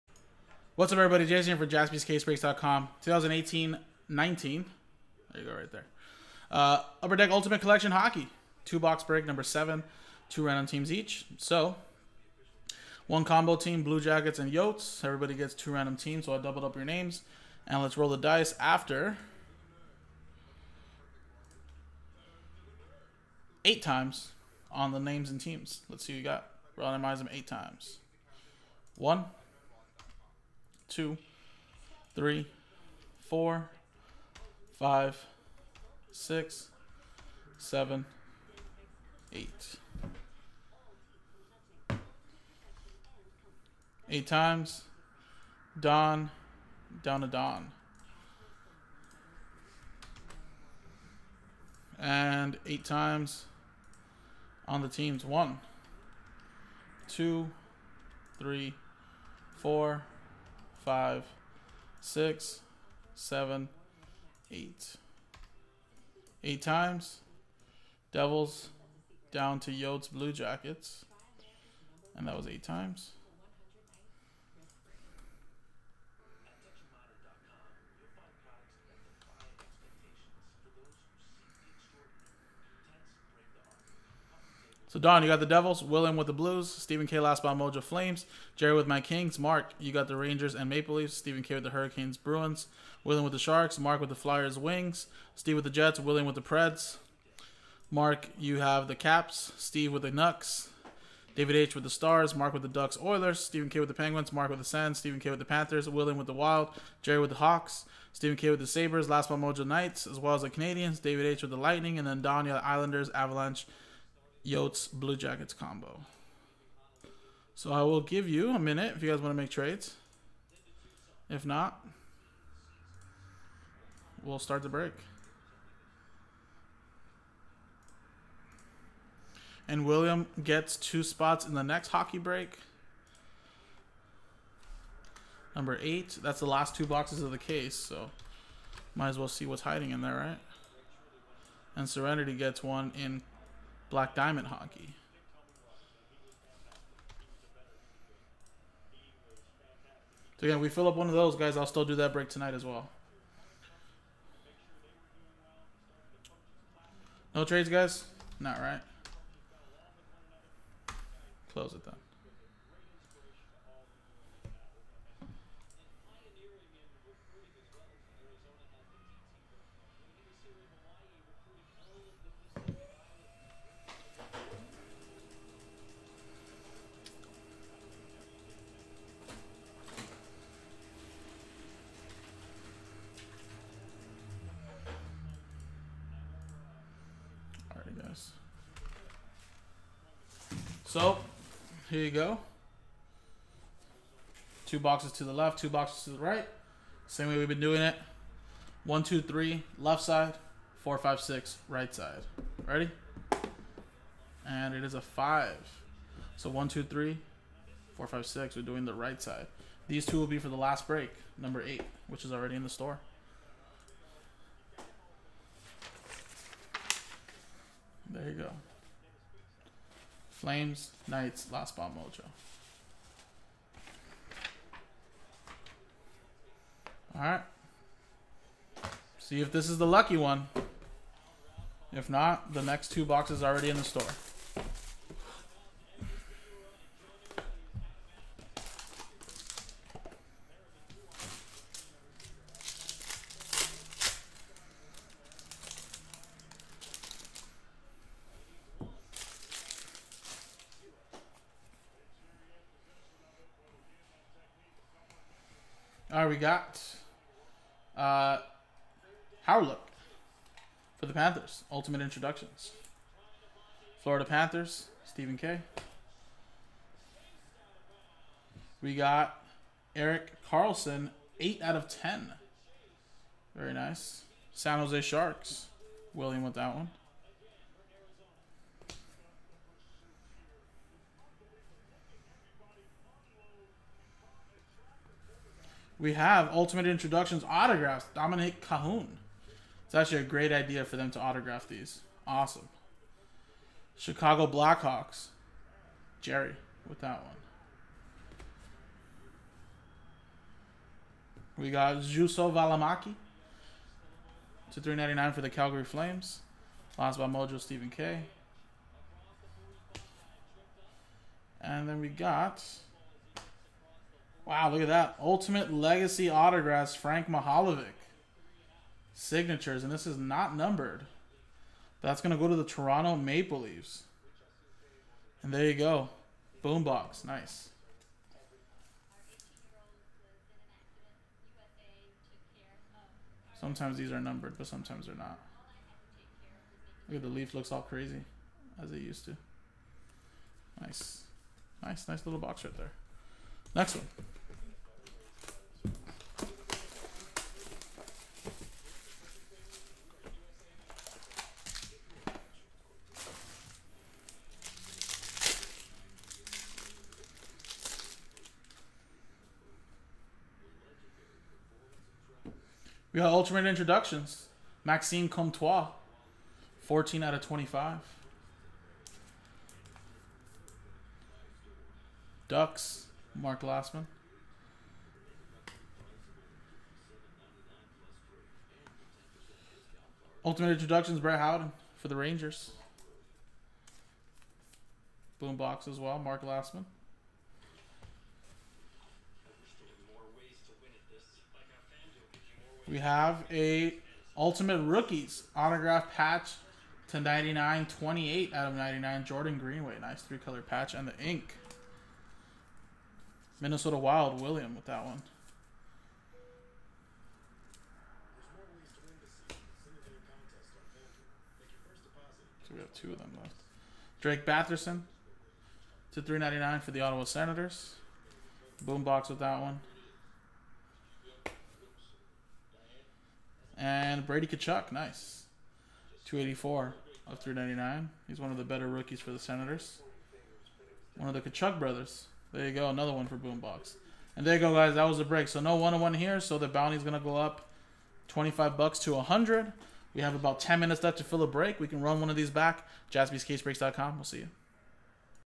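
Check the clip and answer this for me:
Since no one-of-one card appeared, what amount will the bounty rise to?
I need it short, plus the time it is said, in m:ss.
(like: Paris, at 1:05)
100, at 7:19.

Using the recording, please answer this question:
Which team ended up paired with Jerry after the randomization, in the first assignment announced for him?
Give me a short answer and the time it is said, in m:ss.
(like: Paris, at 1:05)
Kings, at 1:28.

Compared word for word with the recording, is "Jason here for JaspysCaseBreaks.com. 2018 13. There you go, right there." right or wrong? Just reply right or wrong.
wrong.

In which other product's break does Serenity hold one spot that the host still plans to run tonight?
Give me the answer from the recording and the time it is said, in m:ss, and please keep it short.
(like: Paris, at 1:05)
Black Diamond Hockey, at 2:23.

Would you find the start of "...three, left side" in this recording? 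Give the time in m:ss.
3:19.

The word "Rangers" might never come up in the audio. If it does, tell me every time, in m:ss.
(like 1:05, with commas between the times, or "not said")
1:30, 6:22.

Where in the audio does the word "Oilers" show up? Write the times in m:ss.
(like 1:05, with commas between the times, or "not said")
1:43.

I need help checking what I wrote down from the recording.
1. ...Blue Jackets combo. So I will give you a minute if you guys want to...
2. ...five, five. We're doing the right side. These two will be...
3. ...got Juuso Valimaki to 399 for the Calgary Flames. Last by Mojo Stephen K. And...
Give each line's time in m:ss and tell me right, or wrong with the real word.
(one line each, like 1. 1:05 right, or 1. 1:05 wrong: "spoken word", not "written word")
1. 1:54 right
2. 3:28 wrong: "six", not "five"
3. 5:01 right.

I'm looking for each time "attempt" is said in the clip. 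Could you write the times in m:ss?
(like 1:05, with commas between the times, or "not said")
not said.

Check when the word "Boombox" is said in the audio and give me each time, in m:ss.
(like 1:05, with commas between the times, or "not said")
5:26, 6:25, 6:58, 7:13.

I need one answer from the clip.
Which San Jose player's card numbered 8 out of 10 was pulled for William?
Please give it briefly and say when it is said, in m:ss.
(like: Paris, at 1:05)
Erik Karlsson, at 4:29.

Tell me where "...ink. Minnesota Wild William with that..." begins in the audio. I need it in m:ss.
6:41.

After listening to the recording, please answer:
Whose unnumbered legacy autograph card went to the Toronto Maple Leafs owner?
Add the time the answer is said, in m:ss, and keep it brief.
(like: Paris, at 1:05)
Frank Mahovlich, at 5:16.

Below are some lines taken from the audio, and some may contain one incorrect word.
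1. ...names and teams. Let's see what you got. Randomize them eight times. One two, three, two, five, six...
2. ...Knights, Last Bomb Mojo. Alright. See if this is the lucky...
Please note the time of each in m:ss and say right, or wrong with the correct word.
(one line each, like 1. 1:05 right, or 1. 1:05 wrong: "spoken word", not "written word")
1. 0:25 wrong: "four", not "two"
2. 3:41 right.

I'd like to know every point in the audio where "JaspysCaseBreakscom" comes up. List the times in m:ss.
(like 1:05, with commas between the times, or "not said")
0:01, 7:23.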